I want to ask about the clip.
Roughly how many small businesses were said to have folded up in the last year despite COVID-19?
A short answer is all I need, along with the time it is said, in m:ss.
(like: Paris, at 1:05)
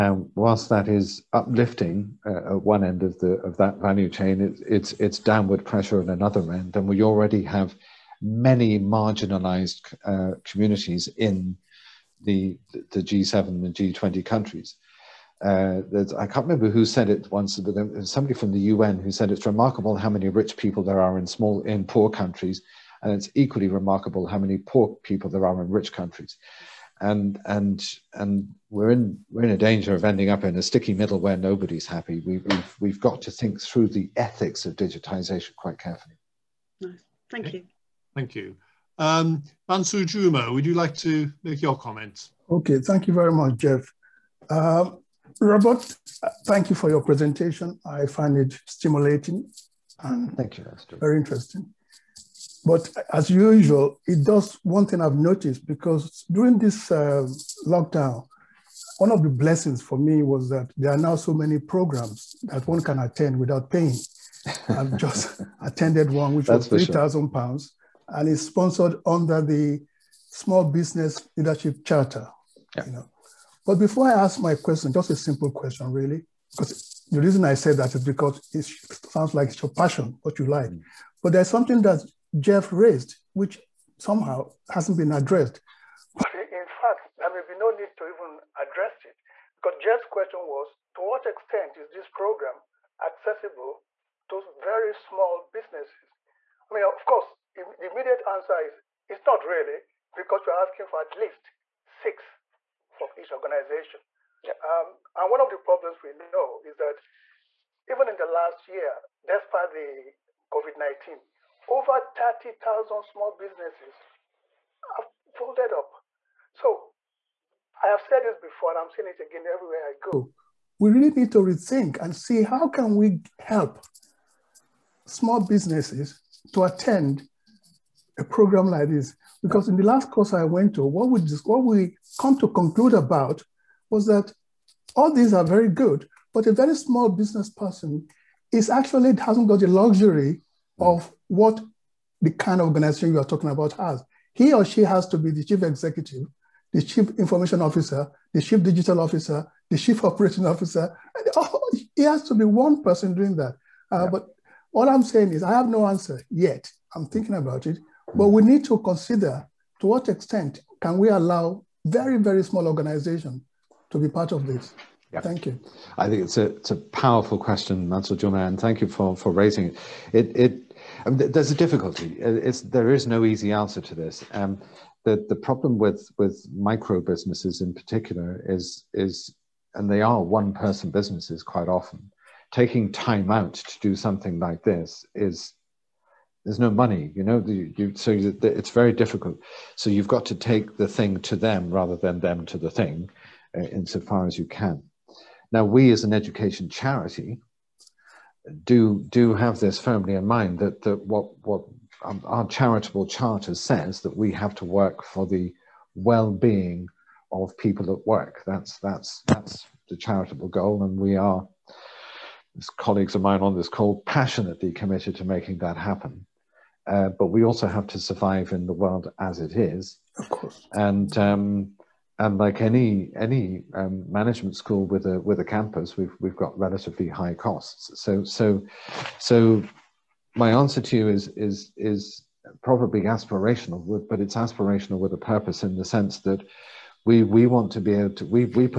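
over 30,000, at 1:51.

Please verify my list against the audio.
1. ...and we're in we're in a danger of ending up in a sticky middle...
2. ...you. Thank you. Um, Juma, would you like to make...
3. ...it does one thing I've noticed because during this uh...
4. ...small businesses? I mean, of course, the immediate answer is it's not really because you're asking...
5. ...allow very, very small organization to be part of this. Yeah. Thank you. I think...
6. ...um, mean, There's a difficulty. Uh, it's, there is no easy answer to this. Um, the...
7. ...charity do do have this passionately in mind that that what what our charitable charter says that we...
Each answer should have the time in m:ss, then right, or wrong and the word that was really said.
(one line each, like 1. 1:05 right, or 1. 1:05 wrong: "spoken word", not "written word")
1. 0:28 right
2. 0:37 right
3. 0:54 right
4. 1:34 right
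5. 2:41 right
6. 2:51 right
7. 3:16 wrong: "firmly", not "passionately".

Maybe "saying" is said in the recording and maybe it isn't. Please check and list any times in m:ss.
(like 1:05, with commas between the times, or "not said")
1:58, 2:35.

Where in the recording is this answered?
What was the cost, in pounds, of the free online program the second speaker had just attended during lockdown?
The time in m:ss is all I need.
1:06.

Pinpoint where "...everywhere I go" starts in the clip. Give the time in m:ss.
1:59.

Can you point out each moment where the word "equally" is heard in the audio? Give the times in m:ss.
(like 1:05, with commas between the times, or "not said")
0:23.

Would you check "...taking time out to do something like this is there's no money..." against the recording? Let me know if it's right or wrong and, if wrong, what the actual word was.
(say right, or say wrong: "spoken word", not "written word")
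right.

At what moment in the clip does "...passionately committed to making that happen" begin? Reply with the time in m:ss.
3:34.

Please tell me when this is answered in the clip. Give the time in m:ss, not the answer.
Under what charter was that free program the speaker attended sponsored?
1:10.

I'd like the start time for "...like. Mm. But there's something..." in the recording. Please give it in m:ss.
1:20.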